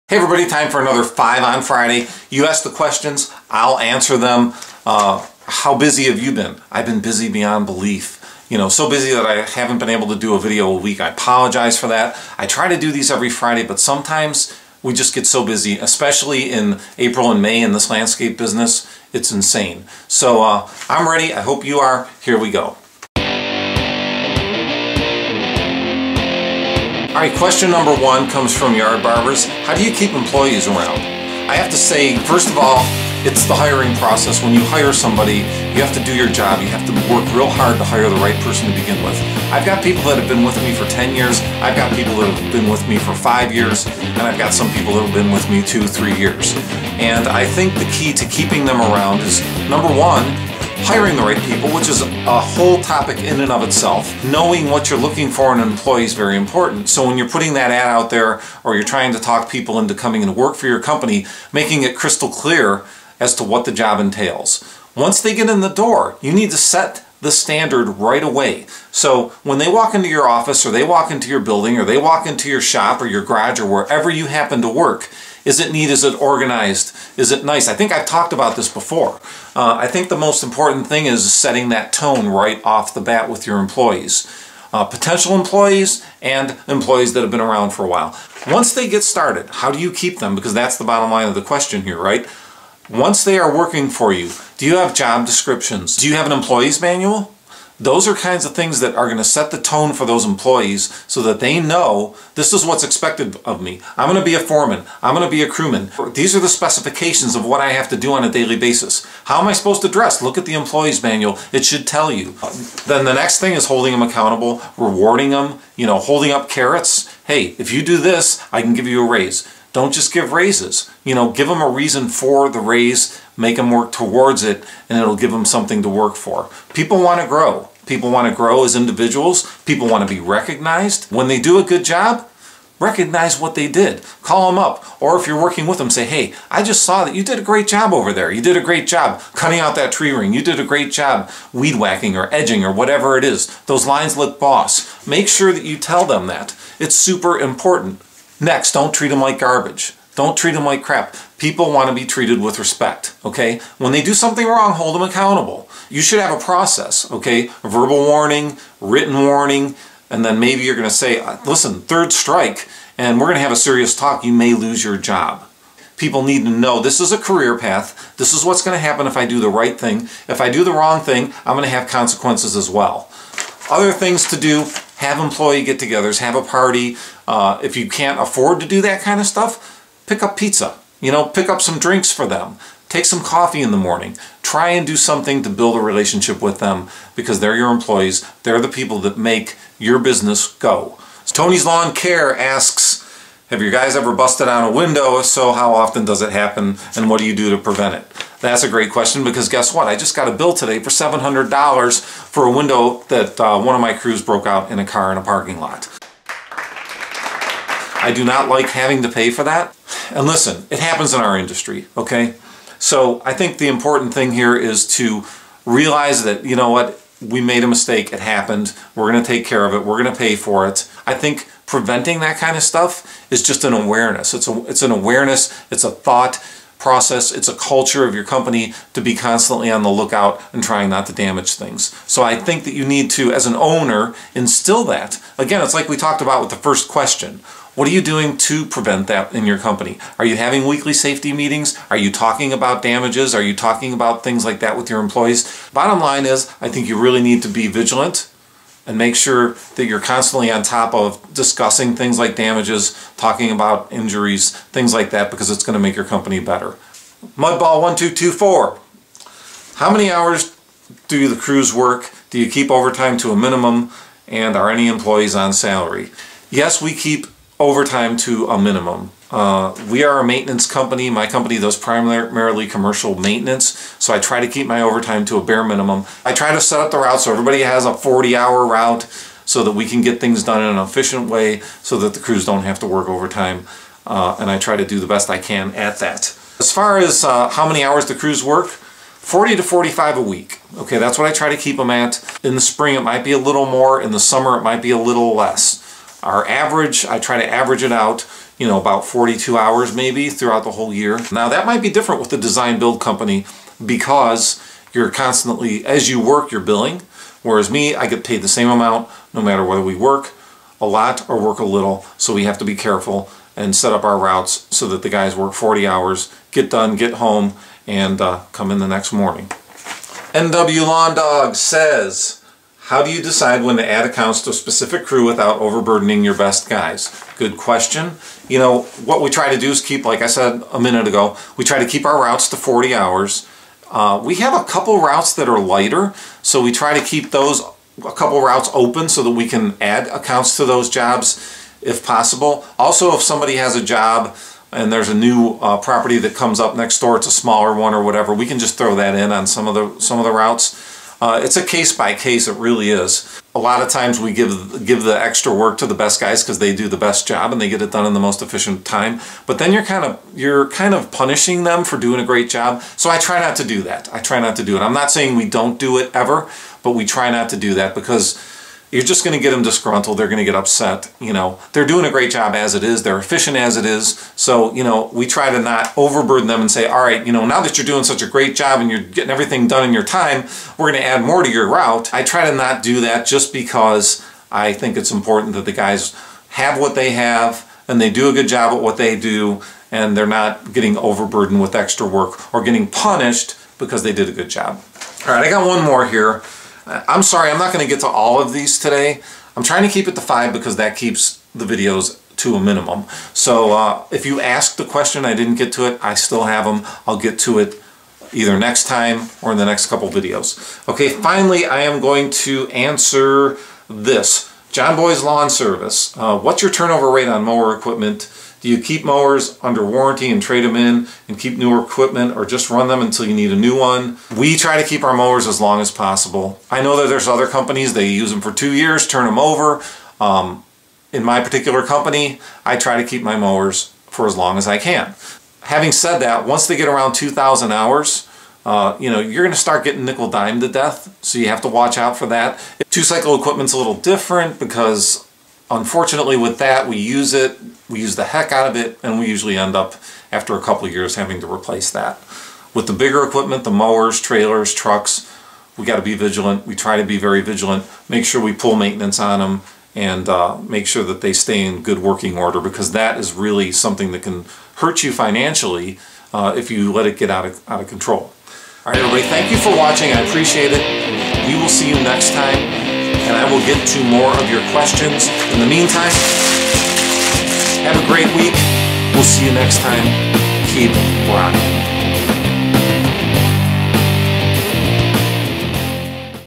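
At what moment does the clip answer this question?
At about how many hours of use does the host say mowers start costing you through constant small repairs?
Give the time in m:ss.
7:17.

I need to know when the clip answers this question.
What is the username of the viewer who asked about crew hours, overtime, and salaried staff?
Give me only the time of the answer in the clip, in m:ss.
4:17.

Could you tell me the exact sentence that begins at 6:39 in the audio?
I'm trying to keep it to five because that keeps the videos to a minimum.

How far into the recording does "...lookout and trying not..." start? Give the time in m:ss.
3:49.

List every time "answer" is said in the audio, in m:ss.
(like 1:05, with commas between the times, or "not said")
0:03, 6:52.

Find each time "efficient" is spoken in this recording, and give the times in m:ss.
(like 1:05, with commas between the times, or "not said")
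4:40, 5:58, 6:13.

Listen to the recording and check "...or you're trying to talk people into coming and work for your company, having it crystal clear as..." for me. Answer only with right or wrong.
wrong.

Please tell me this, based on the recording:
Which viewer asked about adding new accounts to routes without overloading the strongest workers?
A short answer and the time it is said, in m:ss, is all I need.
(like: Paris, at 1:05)
NW Lawn Dog, at 5:20.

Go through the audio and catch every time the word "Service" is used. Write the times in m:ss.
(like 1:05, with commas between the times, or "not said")
6:55.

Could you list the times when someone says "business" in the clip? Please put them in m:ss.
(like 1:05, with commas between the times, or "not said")
0:18, 3:09.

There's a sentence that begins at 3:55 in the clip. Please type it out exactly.
Again, it's like we talked about with the first question what are you doing to prevent that in your company?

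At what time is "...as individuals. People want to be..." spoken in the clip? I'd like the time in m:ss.
2:08.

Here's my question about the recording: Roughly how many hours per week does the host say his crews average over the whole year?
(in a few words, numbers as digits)
42.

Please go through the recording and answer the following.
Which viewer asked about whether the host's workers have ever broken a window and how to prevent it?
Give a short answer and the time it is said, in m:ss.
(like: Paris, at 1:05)
Tony's Lawn Care, at 3:11.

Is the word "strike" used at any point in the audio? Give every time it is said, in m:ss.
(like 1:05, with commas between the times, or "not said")
2:42.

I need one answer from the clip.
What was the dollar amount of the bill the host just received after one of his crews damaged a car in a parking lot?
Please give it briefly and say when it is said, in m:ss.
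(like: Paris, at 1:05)
$700, at 3:20.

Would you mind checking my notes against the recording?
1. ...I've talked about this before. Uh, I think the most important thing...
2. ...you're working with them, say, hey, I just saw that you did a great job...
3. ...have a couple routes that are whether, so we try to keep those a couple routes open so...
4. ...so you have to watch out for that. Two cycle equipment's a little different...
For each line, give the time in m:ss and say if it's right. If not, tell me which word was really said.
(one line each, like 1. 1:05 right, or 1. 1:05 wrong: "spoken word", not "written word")
1. 1:17 right
2. 2:15 right
3. 5:34 wrong: "lighter", not "whether"
4. 7:21 right.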